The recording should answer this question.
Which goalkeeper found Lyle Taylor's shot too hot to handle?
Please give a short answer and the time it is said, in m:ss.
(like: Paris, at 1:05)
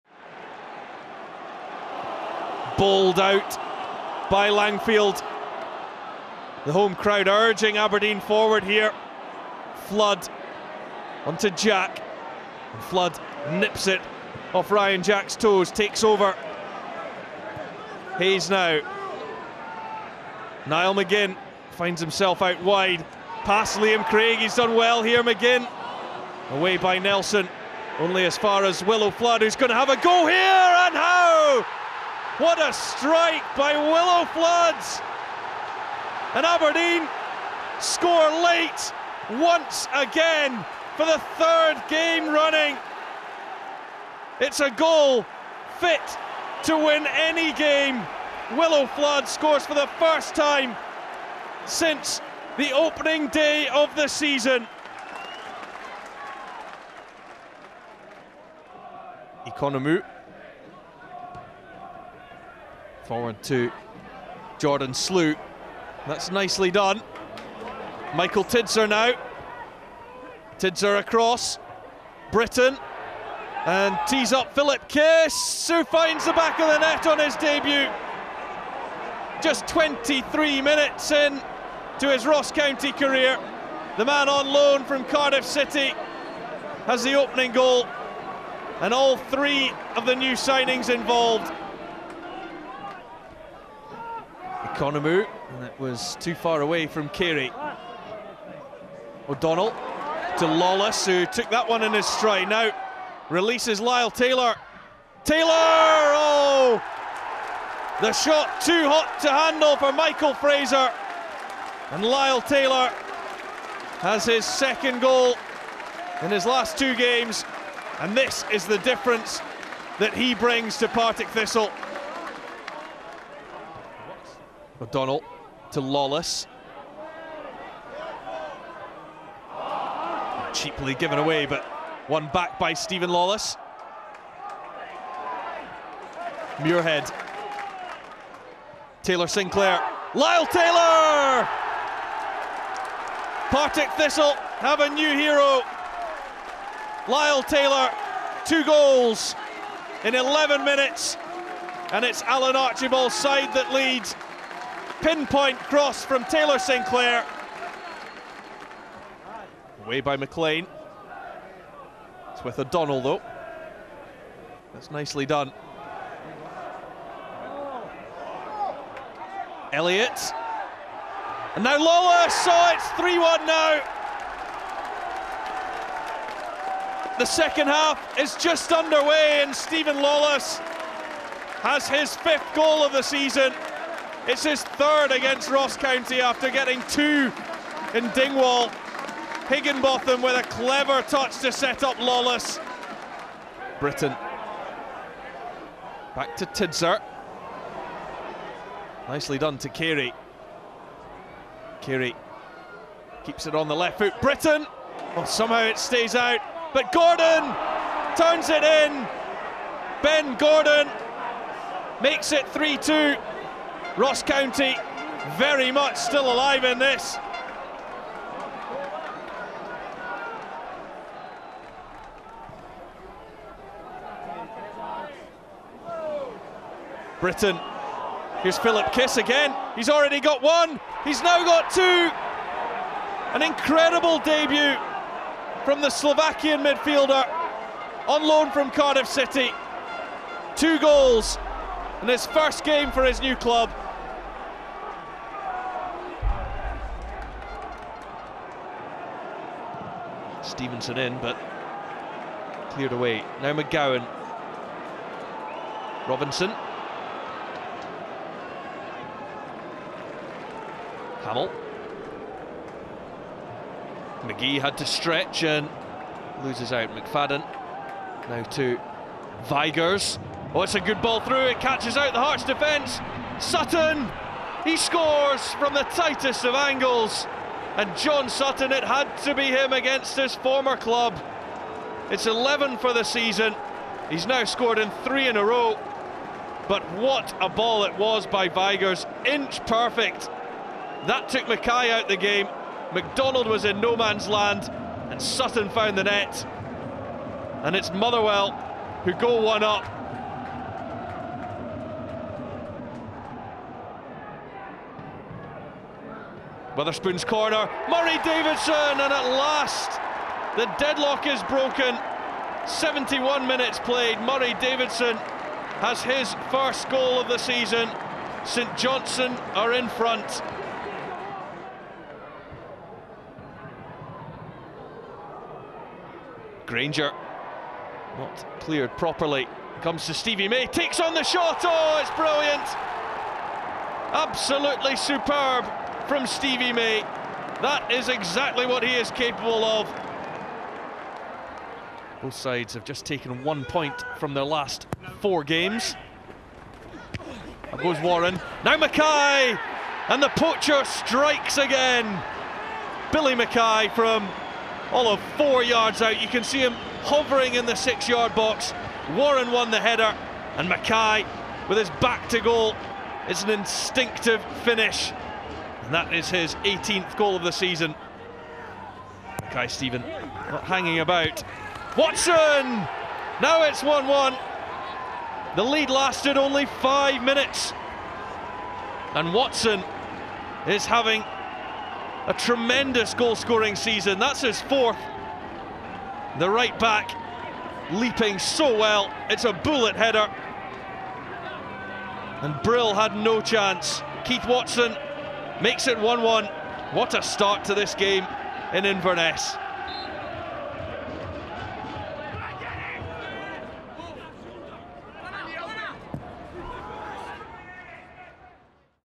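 Michael Fraser, at 1:49.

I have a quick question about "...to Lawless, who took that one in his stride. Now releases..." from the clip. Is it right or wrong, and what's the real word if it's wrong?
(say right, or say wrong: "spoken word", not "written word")
right.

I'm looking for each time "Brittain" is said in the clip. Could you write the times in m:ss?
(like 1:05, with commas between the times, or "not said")
1:12, 3:13, 3:24, 3:47.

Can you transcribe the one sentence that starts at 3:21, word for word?
Carey keeps it on the left foot.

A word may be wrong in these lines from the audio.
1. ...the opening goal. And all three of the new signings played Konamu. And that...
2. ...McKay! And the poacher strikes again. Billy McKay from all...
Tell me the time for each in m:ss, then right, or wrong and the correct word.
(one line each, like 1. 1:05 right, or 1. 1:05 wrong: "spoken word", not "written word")
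1. 1:27 wrong: "involved", not "played"
2. 5:48 right.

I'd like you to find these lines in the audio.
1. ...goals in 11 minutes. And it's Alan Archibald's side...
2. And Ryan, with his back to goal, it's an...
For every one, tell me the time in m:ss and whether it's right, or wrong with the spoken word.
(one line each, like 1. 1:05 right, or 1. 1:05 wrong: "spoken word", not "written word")
1. 2:28 right
2. 6:00 wrong: "McKay", not "Ryan".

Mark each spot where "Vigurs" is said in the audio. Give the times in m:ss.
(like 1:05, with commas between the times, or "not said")
4:29, 4:48.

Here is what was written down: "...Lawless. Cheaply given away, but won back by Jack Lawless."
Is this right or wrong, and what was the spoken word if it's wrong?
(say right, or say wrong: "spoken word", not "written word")
wrong: "Steven", not "Jack".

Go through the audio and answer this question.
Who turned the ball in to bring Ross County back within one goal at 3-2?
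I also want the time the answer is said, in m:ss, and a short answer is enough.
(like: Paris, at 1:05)
Ben Gordon, at 3:30.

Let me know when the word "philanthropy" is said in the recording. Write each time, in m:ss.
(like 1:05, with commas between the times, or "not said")
not said.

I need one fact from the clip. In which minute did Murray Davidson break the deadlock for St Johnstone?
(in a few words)
71.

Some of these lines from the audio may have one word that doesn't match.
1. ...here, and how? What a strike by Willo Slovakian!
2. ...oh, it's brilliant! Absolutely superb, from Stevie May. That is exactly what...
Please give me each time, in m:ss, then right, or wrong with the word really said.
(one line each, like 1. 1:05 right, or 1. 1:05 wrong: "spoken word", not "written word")
1. 0:30 wrong: "Floods", not "Slovakian"
2. 5:31 right.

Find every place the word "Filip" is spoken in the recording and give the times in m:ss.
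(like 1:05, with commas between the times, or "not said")
1:14, 3:48.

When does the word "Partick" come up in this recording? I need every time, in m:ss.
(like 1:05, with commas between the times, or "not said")
2:00, 2:23.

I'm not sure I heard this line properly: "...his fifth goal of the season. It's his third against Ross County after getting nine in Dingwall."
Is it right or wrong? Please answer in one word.
wrong.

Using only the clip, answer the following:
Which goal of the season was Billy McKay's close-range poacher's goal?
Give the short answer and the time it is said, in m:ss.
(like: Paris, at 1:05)
18th, at 6:06.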